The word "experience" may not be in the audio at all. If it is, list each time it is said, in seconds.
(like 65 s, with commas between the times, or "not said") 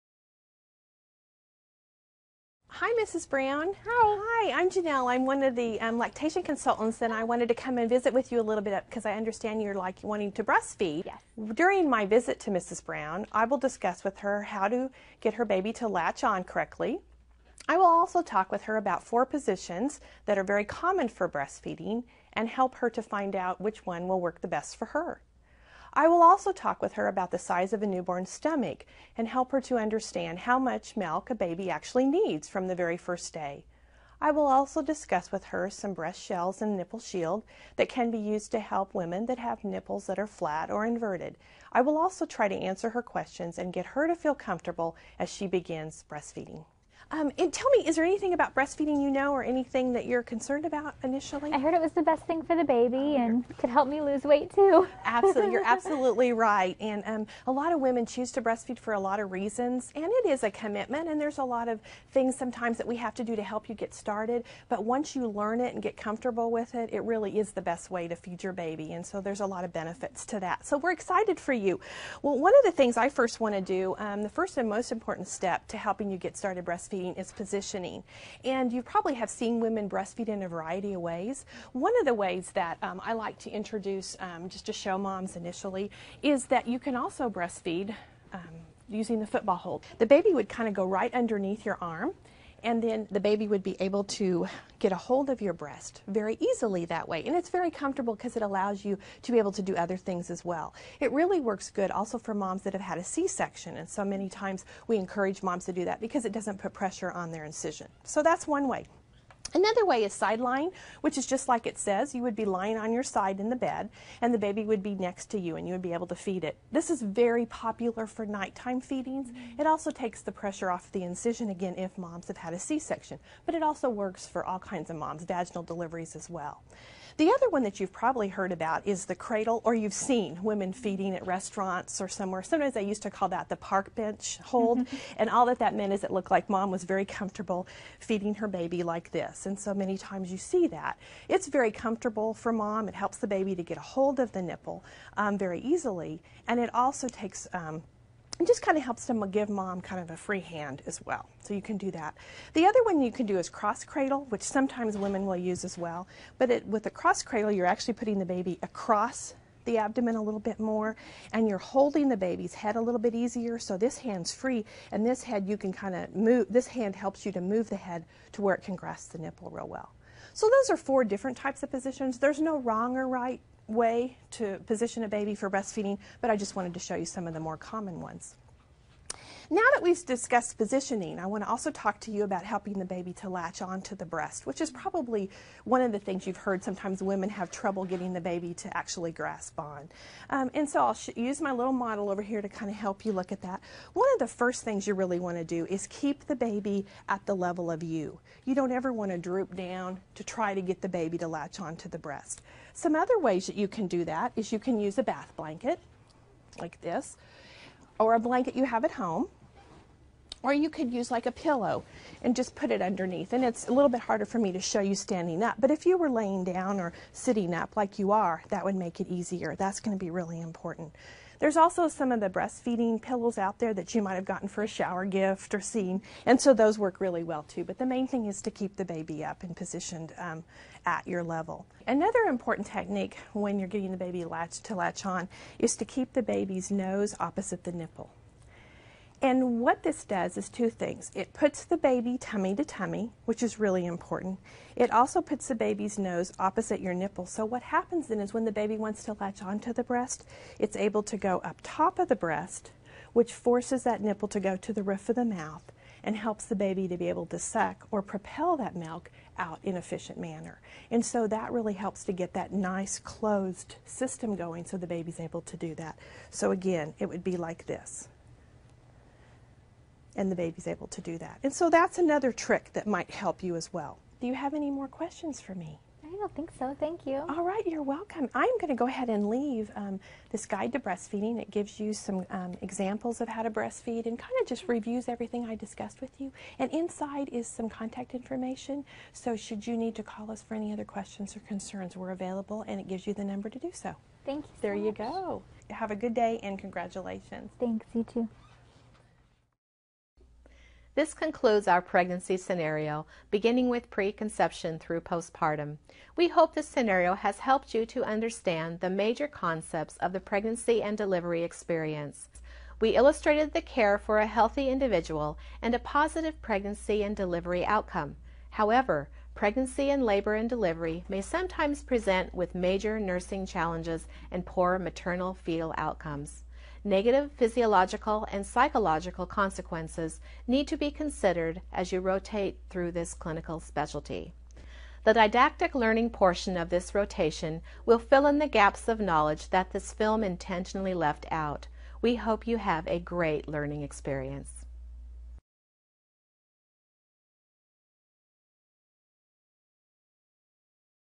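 311 s, 343 s.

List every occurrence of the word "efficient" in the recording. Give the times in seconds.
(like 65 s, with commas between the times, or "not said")
259 s.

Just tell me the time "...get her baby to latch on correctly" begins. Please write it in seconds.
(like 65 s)
15 s.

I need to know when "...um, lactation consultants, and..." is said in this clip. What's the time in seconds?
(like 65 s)
5 s.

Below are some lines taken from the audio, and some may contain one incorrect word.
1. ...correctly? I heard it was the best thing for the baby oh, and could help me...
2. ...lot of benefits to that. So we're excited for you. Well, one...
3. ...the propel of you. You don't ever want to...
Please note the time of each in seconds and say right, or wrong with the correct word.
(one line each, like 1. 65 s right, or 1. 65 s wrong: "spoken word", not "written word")
1. 51 s wrong: "initially", not "correctly"
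2. 69 s right
3. 197 s wrong: "level", not "propel".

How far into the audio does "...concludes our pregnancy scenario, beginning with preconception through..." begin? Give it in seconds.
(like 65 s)
301 s.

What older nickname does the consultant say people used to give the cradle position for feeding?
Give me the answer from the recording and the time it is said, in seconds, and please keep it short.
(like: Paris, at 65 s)
Park bench hold, at 133 s.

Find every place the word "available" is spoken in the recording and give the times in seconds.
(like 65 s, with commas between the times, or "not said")
292 s.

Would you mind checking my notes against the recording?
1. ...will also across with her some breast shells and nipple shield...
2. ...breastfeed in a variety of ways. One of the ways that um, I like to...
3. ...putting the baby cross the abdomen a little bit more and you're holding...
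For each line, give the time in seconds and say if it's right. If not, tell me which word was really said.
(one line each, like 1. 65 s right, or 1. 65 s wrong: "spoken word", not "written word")
1. 34 s wrong: "discuss", not "across"
2. 79 s right
3. 157 s wrong: "across", not "cross".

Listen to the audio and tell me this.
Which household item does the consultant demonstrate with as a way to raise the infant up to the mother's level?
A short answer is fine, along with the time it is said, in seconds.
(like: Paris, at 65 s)
Bath blanket, at 205 s.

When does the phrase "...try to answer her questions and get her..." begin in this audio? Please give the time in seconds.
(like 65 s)
42 s.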